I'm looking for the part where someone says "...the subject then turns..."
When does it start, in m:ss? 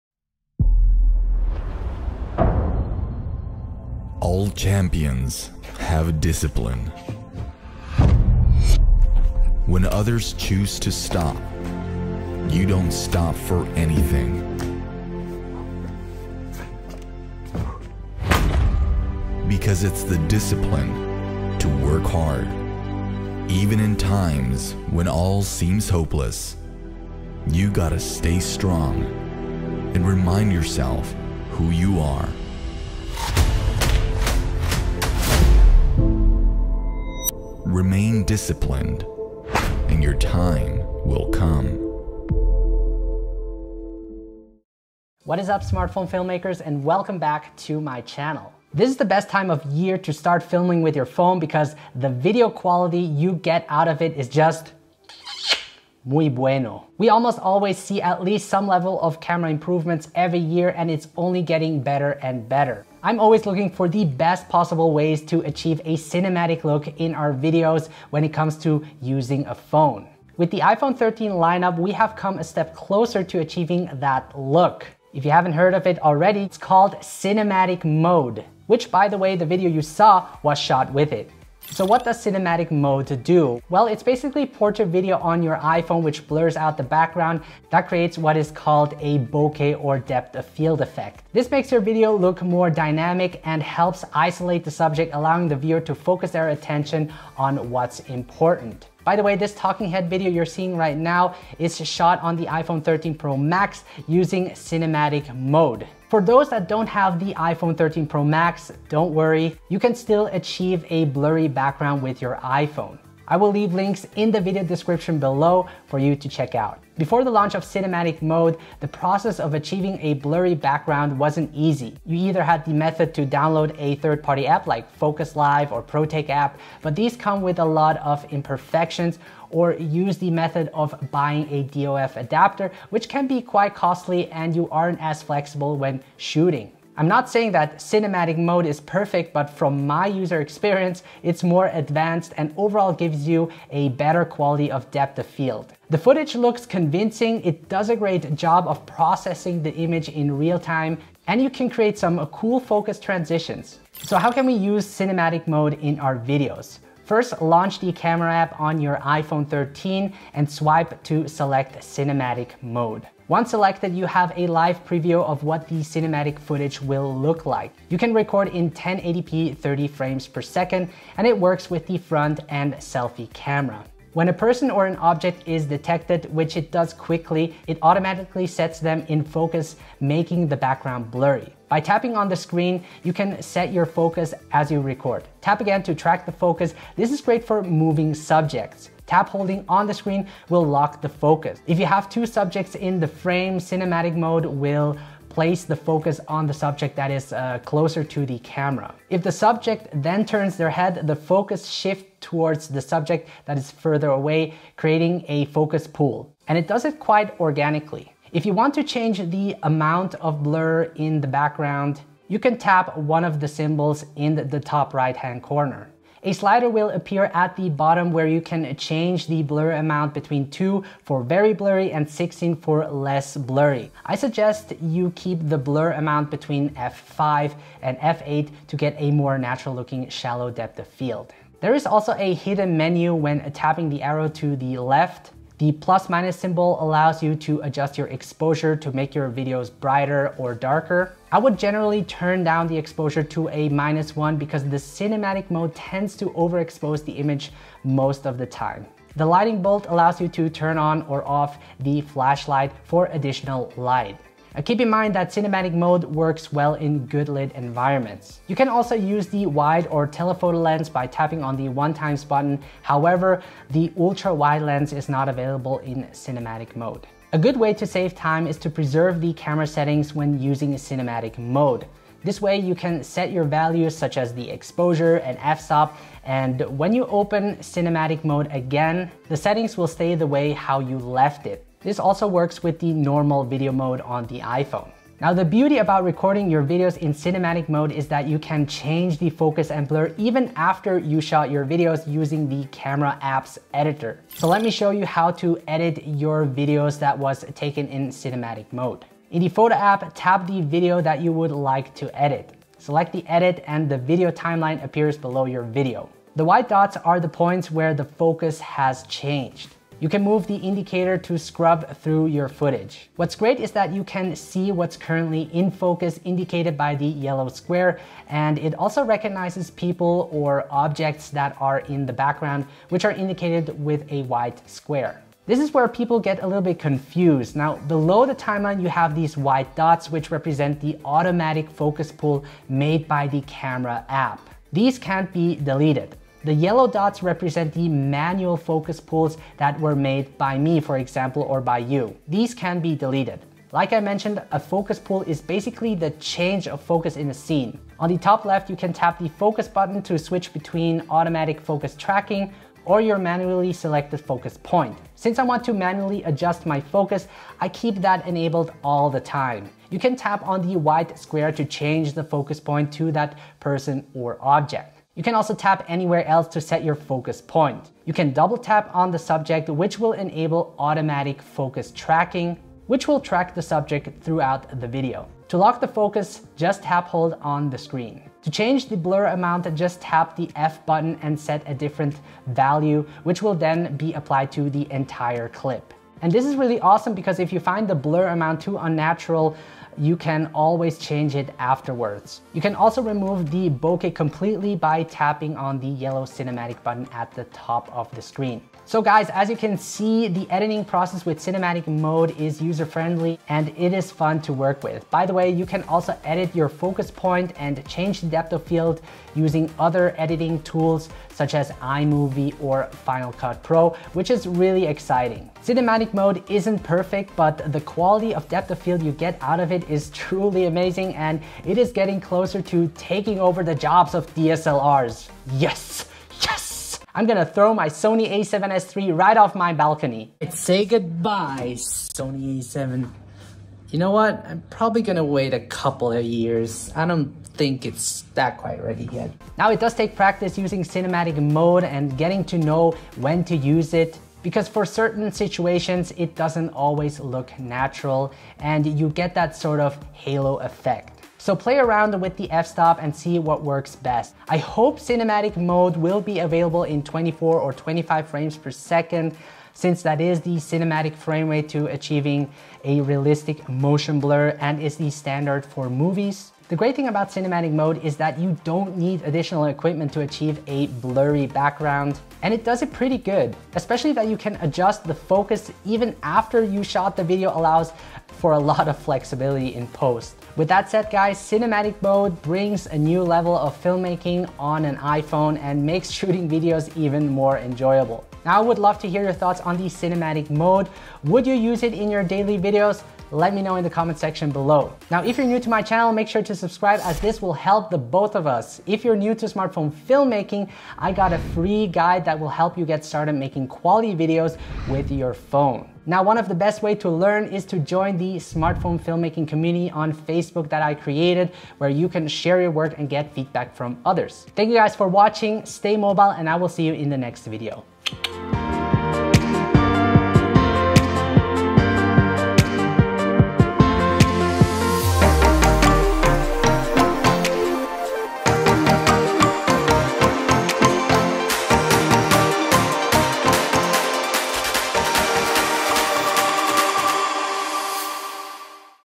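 3:19.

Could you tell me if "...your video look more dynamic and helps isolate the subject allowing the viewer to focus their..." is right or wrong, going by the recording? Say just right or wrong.
right.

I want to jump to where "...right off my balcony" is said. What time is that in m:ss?
7:09.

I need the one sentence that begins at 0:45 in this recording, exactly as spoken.
What is up, smartphone filmmakers, and welcome back to my channel.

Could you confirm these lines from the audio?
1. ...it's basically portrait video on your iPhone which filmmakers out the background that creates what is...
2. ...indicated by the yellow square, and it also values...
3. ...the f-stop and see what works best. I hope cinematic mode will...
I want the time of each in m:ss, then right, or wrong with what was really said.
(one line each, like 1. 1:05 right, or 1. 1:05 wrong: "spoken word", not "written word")
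1. 1:23 wrong: "blurs", not "filmmakers"
2. 5:16 wrong: "recognizes", not "values"
3. 7:32 right.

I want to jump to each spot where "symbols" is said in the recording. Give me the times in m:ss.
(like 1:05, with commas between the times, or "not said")
3:33, 3:56.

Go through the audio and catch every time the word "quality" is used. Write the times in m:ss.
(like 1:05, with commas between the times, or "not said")
0:52, 2:24, 6:57, 8:23.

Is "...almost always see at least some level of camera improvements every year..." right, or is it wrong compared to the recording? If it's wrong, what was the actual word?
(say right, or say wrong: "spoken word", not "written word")
right.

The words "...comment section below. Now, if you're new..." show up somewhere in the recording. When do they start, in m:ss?
8:13.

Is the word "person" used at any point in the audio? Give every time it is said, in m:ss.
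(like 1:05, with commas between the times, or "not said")
2:54, 6:03.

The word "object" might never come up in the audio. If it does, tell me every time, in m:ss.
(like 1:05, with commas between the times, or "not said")
2:54, 5:20, 6:04.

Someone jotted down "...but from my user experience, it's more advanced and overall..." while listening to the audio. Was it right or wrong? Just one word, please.
right.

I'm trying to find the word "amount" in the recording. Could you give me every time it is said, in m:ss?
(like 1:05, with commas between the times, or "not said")
3:29, 3:39, 3:45, 6:19, 6:28.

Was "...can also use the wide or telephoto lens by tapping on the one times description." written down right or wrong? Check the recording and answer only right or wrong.
wrong.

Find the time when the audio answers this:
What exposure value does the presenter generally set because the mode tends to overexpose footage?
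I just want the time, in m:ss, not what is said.
4:03.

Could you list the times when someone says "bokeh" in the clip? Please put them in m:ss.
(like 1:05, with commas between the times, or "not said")
1:29, 6:33.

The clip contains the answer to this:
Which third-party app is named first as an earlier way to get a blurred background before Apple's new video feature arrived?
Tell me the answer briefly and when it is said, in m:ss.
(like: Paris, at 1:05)
Focus Live, at 2:04.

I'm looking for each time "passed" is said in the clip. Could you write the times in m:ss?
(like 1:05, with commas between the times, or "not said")
not said.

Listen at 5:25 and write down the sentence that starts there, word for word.
This is where people get a little bit confused.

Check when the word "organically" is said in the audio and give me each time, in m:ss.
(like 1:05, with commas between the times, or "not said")
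3:27.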